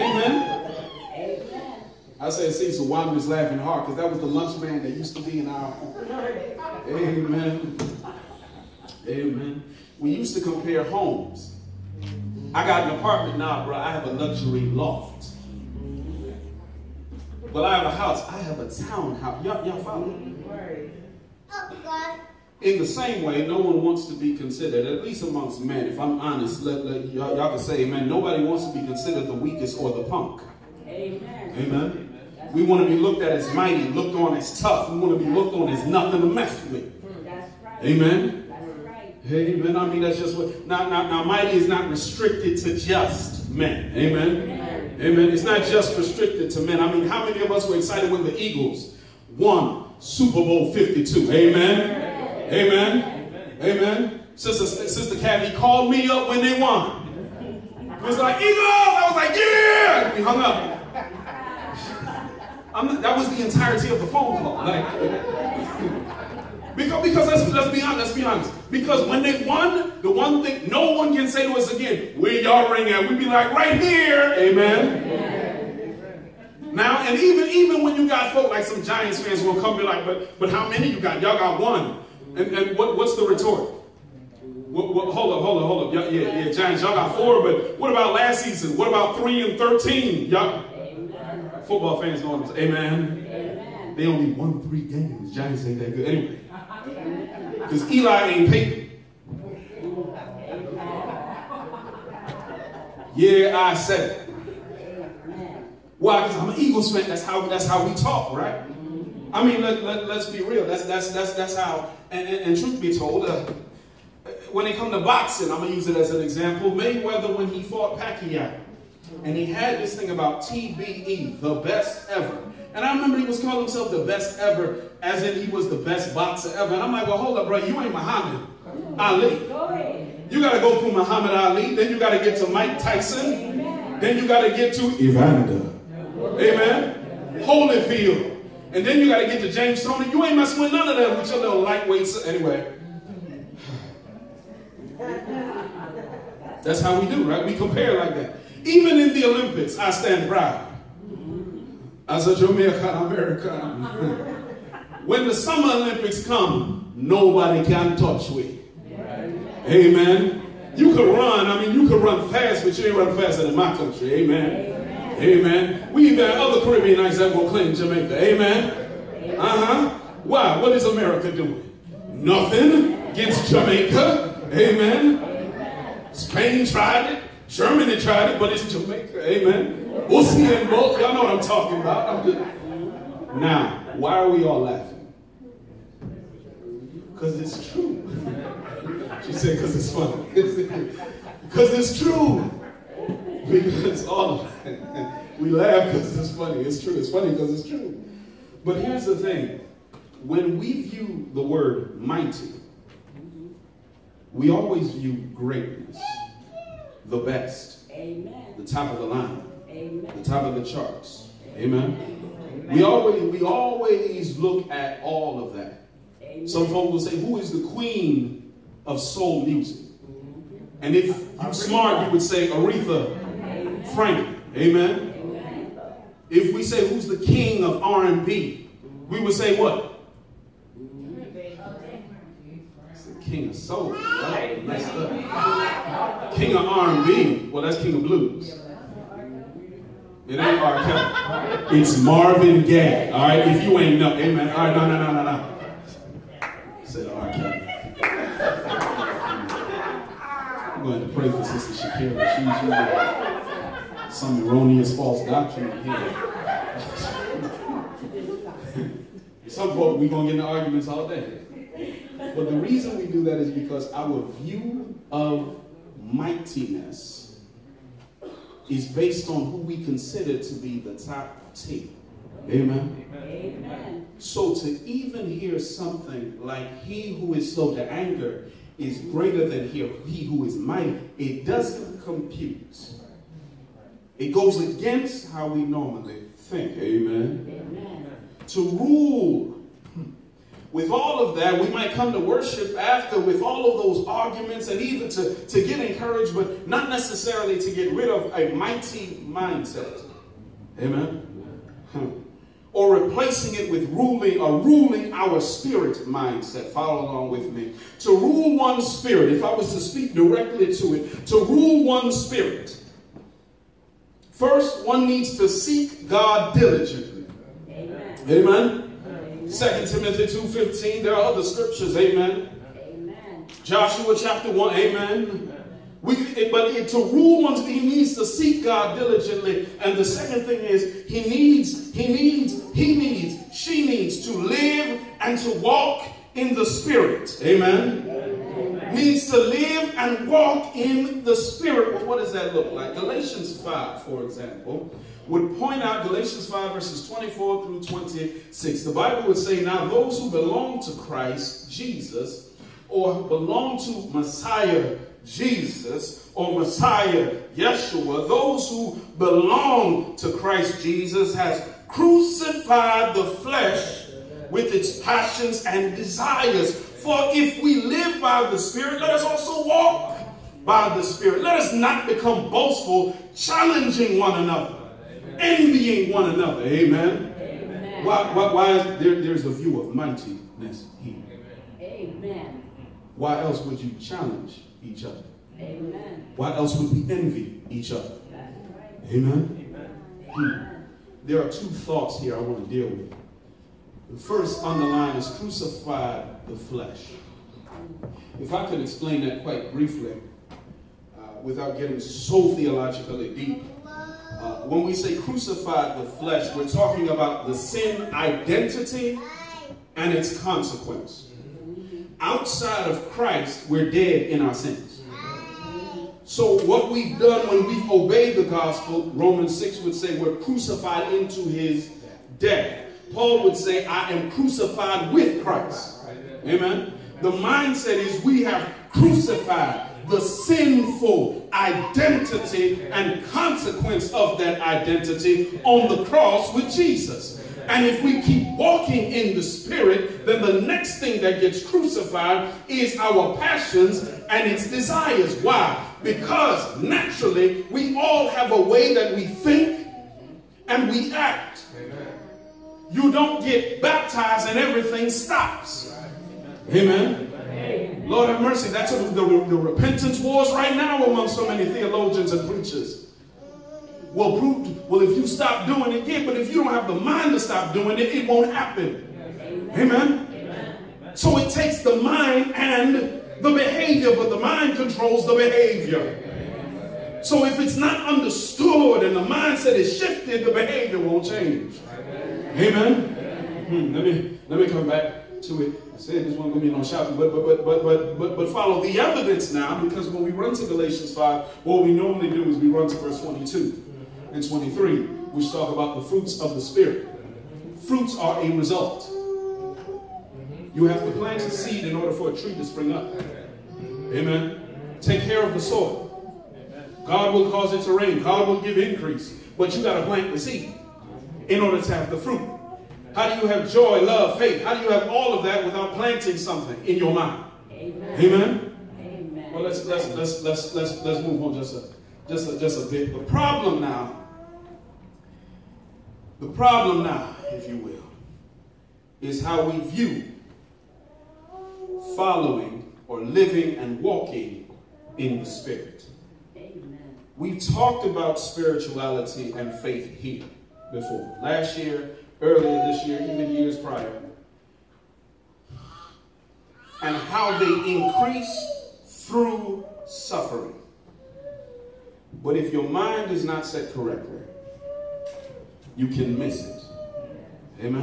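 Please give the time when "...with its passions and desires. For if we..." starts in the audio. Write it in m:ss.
6:04.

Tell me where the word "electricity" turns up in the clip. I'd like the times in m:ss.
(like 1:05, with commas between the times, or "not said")
not said.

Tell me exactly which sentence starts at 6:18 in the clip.
Why, why, why is there, there's a view of mightiness here.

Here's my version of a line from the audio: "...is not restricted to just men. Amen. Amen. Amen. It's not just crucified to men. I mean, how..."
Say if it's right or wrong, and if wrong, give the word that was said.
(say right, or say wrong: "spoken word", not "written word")
wrong: "restricted", not "crucified".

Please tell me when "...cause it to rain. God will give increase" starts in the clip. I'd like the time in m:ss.
8:27.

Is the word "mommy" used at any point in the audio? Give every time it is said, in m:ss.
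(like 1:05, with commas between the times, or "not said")
not said.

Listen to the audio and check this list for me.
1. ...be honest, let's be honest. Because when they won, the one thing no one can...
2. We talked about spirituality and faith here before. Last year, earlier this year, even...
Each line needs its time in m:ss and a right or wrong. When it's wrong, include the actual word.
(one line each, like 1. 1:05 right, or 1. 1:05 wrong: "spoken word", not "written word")
1. 1:07 right
2. 8:57 right.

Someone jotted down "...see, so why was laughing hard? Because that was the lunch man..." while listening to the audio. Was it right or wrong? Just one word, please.
right.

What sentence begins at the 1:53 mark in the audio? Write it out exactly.
Uh, when it comes to boxing, I'm going to use it as an example.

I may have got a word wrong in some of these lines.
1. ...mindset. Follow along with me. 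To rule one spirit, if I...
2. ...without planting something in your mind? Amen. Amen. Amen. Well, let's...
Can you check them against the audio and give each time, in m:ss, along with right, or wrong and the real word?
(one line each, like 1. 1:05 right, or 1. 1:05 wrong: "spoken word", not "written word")
1. 5:06 right
2. 8:35 right.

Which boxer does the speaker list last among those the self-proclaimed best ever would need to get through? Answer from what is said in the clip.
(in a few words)
James Toney.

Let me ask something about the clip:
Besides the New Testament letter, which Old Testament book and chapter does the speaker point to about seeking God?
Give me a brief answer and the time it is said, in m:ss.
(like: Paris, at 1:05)
Joshua 1, at 5:23.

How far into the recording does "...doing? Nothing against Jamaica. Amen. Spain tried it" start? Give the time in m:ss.
2:51.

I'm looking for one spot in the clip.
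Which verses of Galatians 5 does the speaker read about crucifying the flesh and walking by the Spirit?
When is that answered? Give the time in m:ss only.
5:46.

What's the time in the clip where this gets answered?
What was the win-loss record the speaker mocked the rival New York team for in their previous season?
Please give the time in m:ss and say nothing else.
1:29.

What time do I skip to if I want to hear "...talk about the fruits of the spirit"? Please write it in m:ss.
8:15.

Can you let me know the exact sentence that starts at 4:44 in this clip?
It goes against how we normally think.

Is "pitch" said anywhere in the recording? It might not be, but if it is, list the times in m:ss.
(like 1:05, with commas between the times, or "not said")
not said.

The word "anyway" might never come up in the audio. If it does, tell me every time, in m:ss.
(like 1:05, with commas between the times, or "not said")
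1:36, 2:22.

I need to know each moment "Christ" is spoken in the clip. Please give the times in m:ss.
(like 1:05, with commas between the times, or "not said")
5:50, 6:00, 6:53, 7:05.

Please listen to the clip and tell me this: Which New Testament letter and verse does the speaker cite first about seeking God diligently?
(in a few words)
2 Timothy 2:15.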